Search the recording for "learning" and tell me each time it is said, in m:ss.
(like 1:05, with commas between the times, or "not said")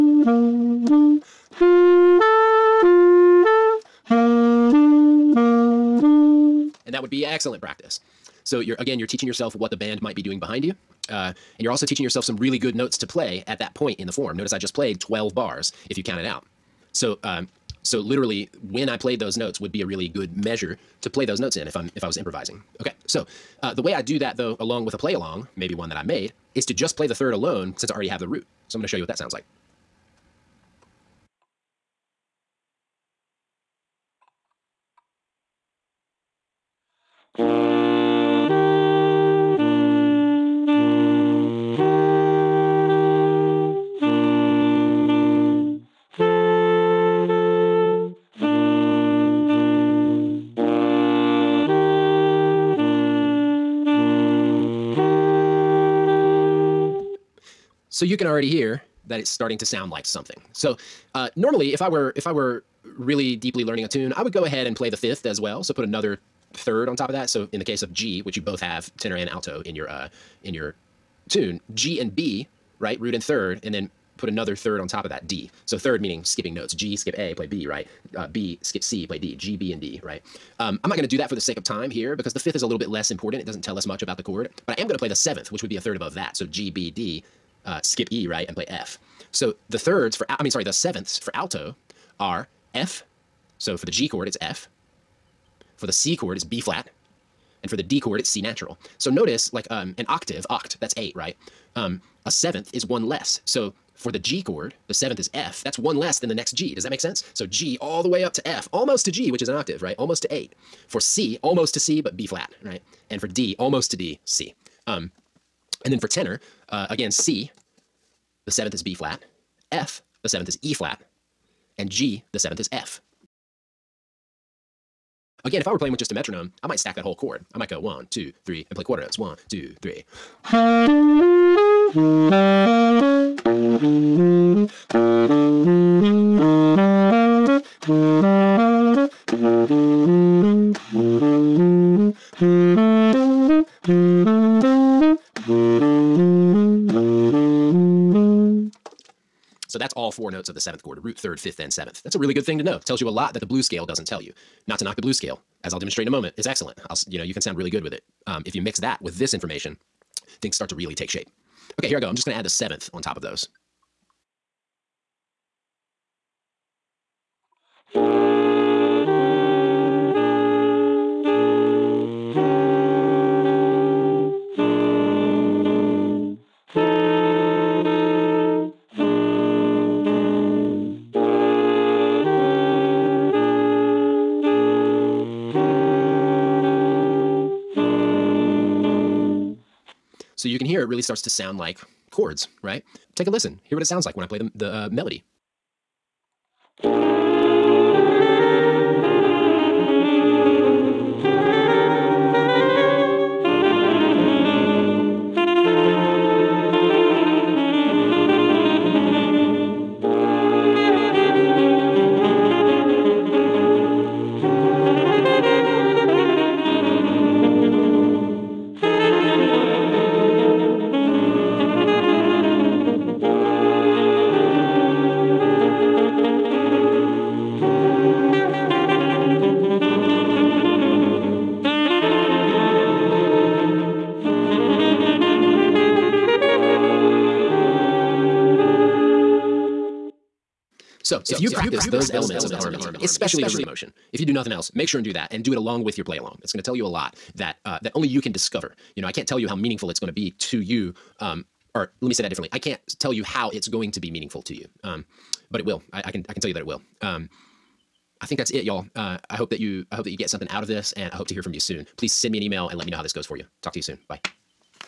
1:03.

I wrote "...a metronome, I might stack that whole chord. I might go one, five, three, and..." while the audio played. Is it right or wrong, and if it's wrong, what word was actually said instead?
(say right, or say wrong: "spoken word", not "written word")
wrong: "two", not "five".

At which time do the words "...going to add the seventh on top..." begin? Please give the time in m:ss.
2:42.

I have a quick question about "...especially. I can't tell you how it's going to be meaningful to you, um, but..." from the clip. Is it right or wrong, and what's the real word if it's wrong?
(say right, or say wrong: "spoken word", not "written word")
wrong: "differently", not "especially".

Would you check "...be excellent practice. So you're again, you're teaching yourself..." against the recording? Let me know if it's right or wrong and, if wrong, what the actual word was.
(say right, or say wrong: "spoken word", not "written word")
right.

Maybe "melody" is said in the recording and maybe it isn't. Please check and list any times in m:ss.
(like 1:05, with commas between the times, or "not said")
3:14.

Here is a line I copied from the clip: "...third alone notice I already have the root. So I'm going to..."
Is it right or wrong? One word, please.
wrong.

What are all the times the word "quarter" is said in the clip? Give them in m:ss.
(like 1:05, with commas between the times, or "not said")
2:08.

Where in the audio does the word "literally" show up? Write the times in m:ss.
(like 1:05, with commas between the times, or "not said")
0:17.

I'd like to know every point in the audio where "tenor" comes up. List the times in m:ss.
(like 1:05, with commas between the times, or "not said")
1:08, 1:56.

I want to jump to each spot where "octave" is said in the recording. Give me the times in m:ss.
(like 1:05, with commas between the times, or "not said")
1:40, 1:49.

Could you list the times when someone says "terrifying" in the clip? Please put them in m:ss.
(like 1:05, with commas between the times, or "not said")
not said.